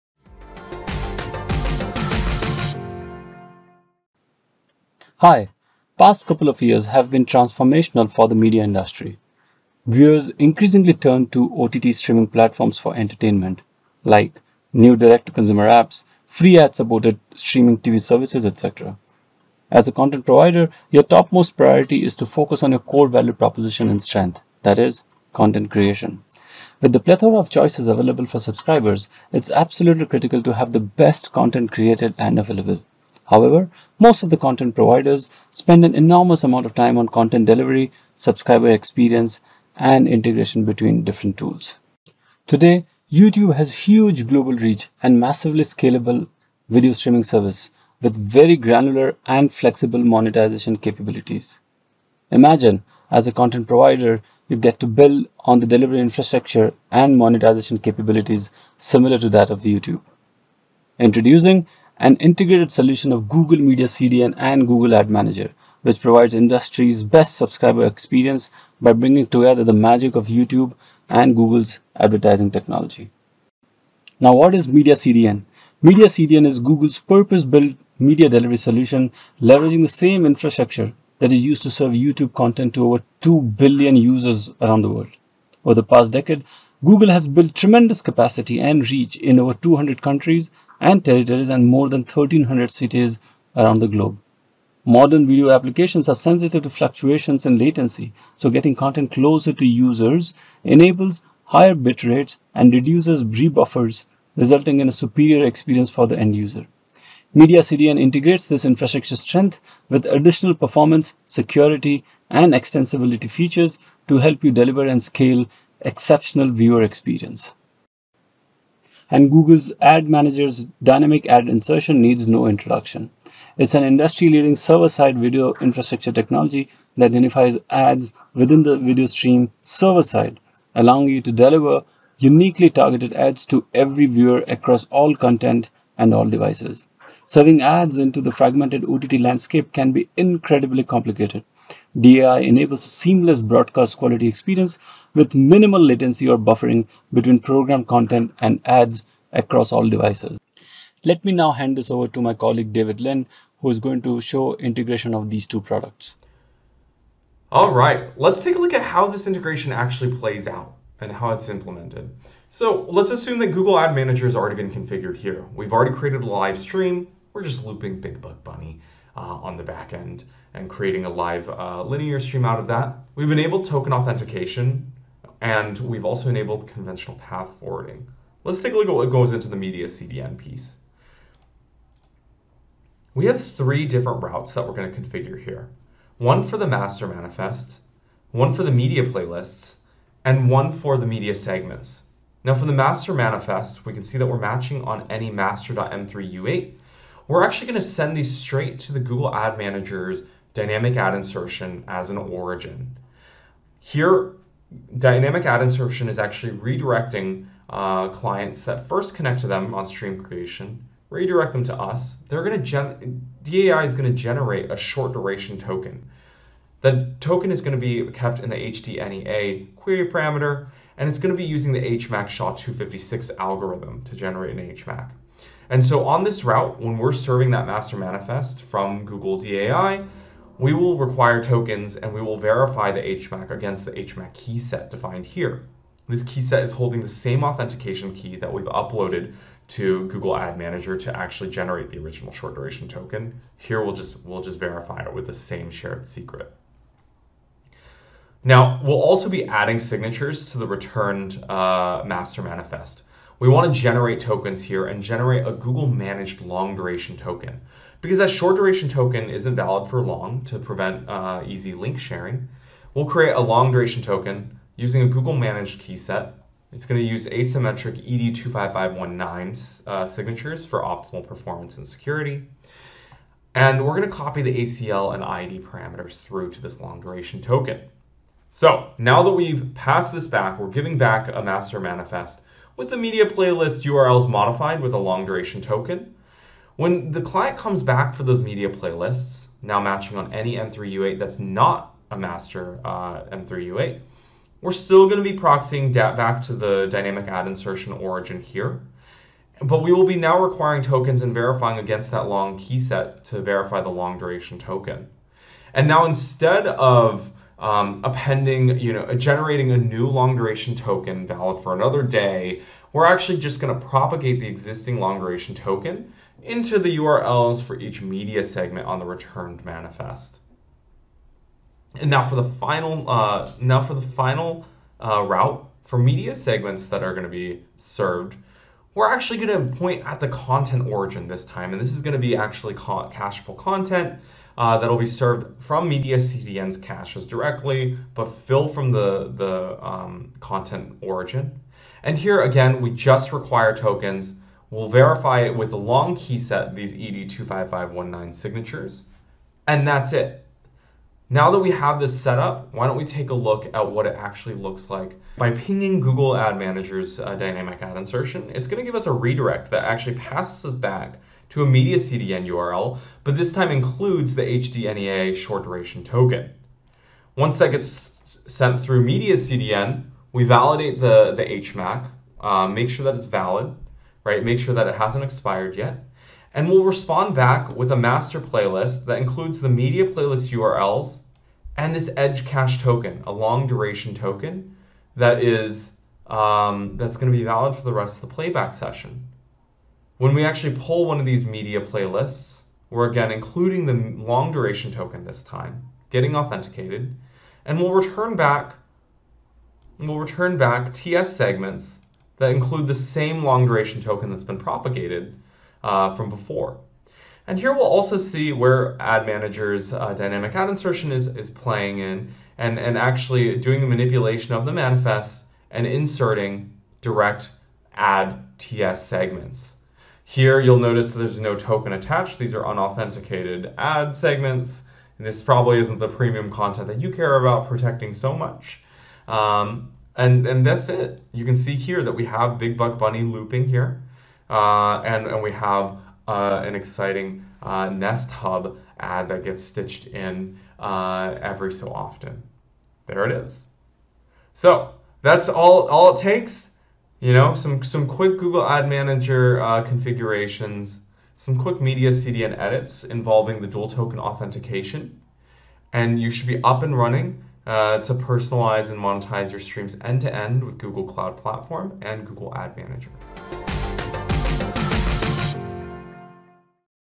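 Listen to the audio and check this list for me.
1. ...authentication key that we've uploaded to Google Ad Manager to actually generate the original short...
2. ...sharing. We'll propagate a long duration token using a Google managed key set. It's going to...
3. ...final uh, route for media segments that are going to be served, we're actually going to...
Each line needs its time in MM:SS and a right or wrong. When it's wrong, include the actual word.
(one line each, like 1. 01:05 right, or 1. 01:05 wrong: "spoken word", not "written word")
1. 03:57 right
2. 04:21 wrong: "create", not "propagate"
3. 05:24 right.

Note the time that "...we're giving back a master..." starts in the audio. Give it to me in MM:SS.
04:40.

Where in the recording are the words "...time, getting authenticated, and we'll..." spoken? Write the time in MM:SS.
06:35.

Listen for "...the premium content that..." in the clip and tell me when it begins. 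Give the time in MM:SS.
07:05.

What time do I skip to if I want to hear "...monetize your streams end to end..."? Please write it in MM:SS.
07:38.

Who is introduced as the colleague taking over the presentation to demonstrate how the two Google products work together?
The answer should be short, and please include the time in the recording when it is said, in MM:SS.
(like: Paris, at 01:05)
David Lin, at 02:32.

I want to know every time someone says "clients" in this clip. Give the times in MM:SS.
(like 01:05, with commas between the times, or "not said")
03:28, 04:47.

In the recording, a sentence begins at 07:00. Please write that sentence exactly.
Here you'll notice there's no token attached.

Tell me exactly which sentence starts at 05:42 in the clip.
And here again, we just require tokens.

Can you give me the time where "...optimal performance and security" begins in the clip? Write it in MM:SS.
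04:30.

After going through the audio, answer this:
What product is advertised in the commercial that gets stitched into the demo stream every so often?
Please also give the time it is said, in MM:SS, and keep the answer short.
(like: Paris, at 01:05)
Nest Hub, at 07:17.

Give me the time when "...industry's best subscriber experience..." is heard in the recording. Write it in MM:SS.
01:06.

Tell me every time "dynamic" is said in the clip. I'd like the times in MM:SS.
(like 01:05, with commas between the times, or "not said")
02:00, 03:20, 03:24, 04:56, 05:57, 06:50.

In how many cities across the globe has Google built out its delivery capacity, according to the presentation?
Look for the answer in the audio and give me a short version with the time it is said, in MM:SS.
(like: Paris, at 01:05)
1300, at 01:31.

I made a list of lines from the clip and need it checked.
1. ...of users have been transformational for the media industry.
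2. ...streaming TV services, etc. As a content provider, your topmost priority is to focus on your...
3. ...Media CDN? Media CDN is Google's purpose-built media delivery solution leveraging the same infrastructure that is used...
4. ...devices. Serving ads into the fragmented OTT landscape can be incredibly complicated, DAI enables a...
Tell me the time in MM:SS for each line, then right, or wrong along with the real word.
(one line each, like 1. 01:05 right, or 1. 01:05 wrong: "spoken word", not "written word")
1. 00:06 wrong: "years", not "users"
2. 00:17 right
3. 01:14 right
4. 02:16 right.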